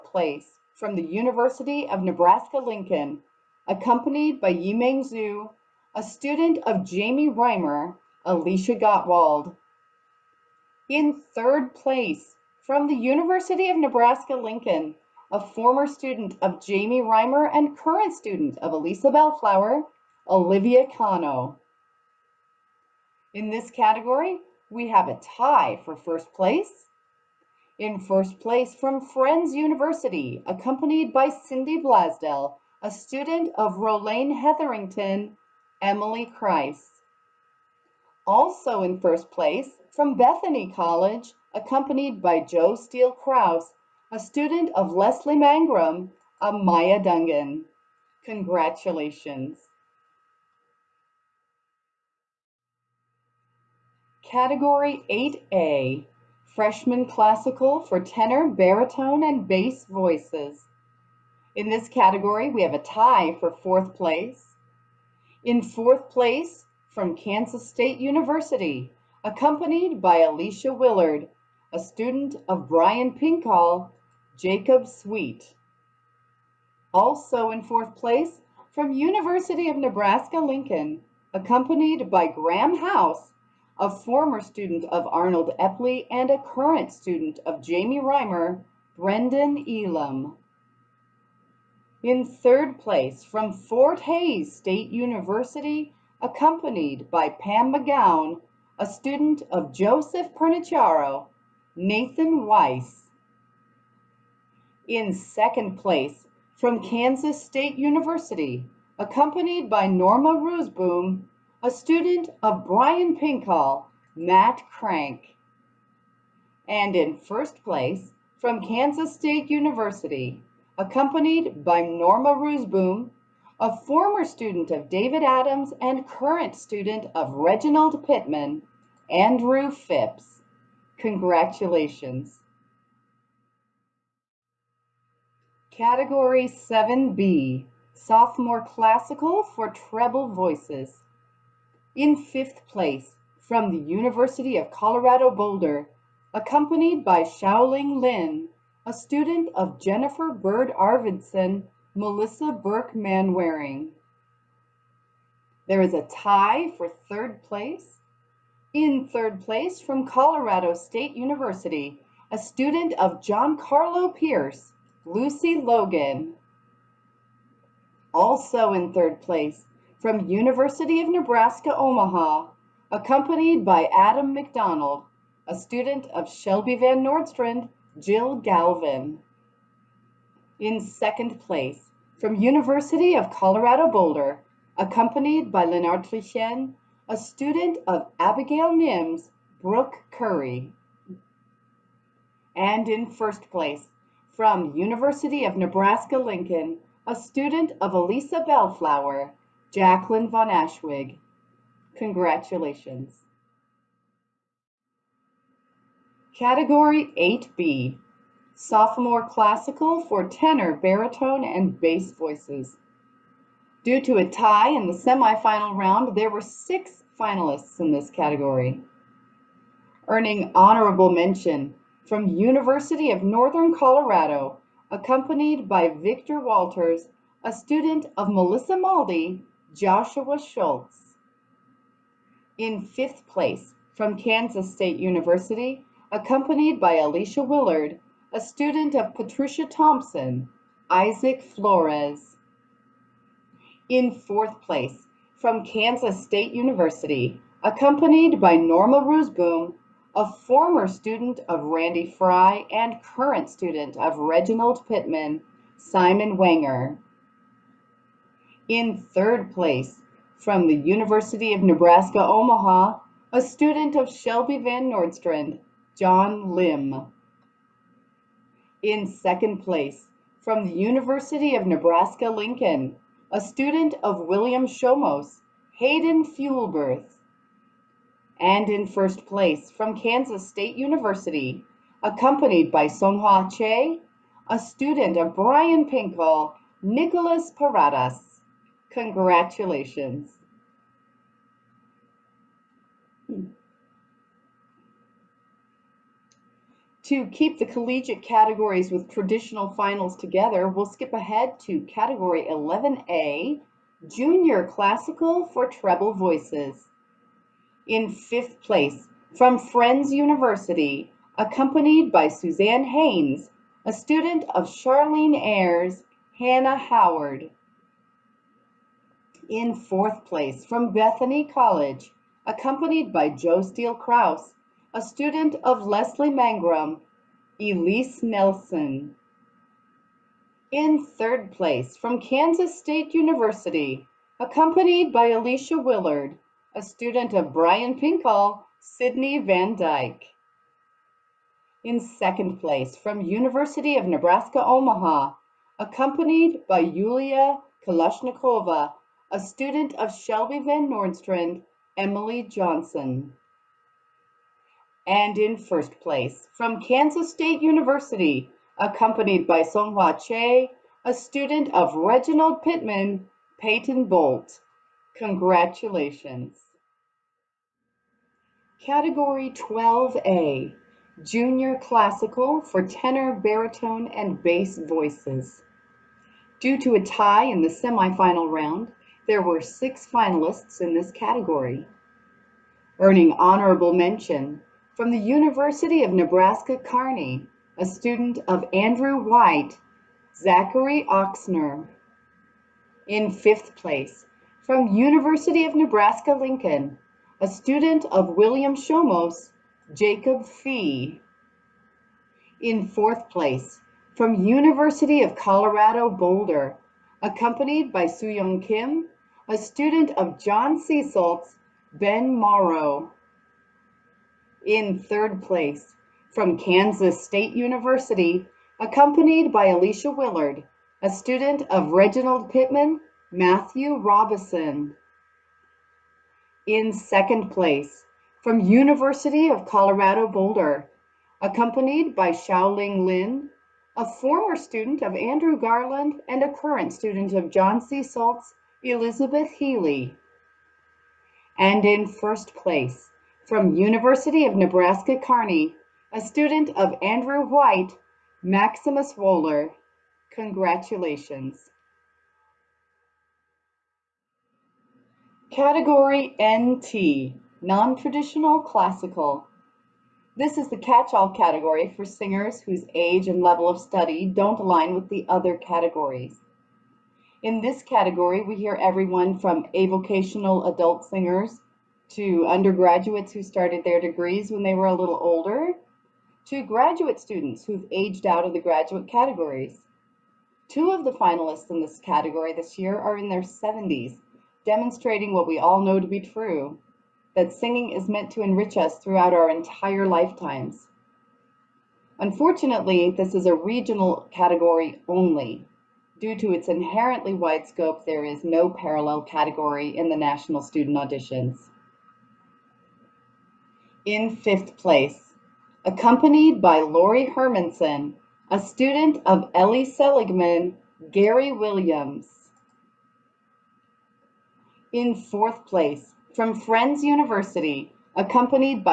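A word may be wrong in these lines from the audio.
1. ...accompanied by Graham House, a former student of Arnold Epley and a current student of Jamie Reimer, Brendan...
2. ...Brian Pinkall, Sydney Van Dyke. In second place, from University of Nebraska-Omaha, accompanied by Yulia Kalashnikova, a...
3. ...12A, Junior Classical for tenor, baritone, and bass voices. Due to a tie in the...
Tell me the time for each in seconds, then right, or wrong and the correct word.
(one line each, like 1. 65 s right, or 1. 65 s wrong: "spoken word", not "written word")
1. 81 s right
2. 337 s right
3. 369 s right.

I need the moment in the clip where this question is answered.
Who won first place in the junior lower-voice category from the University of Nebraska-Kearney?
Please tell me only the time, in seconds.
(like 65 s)
448 s.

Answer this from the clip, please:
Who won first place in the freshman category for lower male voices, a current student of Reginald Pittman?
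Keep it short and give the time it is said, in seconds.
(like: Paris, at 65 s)
Andrew Phipps, at 129 s.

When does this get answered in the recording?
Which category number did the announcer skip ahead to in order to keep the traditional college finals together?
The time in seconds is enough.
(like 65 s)
302 s.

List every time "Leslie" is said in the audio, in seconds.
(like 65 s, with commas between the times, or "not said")
44 s, 325 s.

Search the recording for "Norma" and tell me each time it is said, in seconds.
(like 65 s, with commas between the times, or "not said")
109 s, 121 s, 248 s.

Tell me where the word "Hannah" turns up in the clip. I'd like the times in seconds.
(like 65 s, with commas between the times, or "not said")
316 s.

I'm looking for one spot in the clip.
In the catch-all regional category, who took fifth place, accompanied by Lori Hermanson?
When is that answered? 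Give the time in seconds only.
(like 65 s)
511 s.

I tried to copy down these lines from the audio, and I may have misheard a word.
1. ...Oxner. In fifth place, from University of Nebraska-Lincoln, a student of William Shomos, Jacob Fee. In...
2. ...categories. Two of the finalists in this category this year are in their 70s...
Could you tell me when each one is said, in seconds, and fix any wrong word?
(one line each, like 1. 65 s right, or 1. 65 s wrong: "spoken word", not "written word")
1. 391 s right
2. 479 s right.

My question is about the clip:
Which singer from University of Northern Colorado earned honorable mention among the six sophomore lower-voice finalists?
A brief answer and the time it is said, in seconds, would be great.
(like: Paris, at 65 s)
Joshua Schultz, at 229 s.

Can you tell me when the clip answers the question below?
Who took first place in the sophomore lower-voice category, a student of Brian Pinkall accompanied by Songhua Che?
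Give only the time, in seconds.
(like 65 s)
286 s.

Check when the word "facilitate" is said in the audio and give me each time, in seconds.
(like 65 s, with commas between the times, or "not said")
not said.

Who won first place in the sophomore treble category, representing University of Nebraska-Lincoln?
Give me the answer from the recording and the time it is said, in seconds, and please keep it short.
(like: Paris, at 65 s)
Jacqueline von Ashwig, at 199 s.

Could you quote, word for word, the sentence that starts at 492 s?
Unfortunately, this is a regional category only.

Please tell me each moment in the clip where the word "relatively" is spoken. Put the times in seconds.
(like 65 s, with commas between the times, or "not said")
not said.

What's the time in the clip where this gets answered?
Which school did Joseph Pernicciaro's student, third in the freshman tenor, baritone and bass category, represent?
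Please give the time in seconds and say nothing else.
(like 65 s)
93 s.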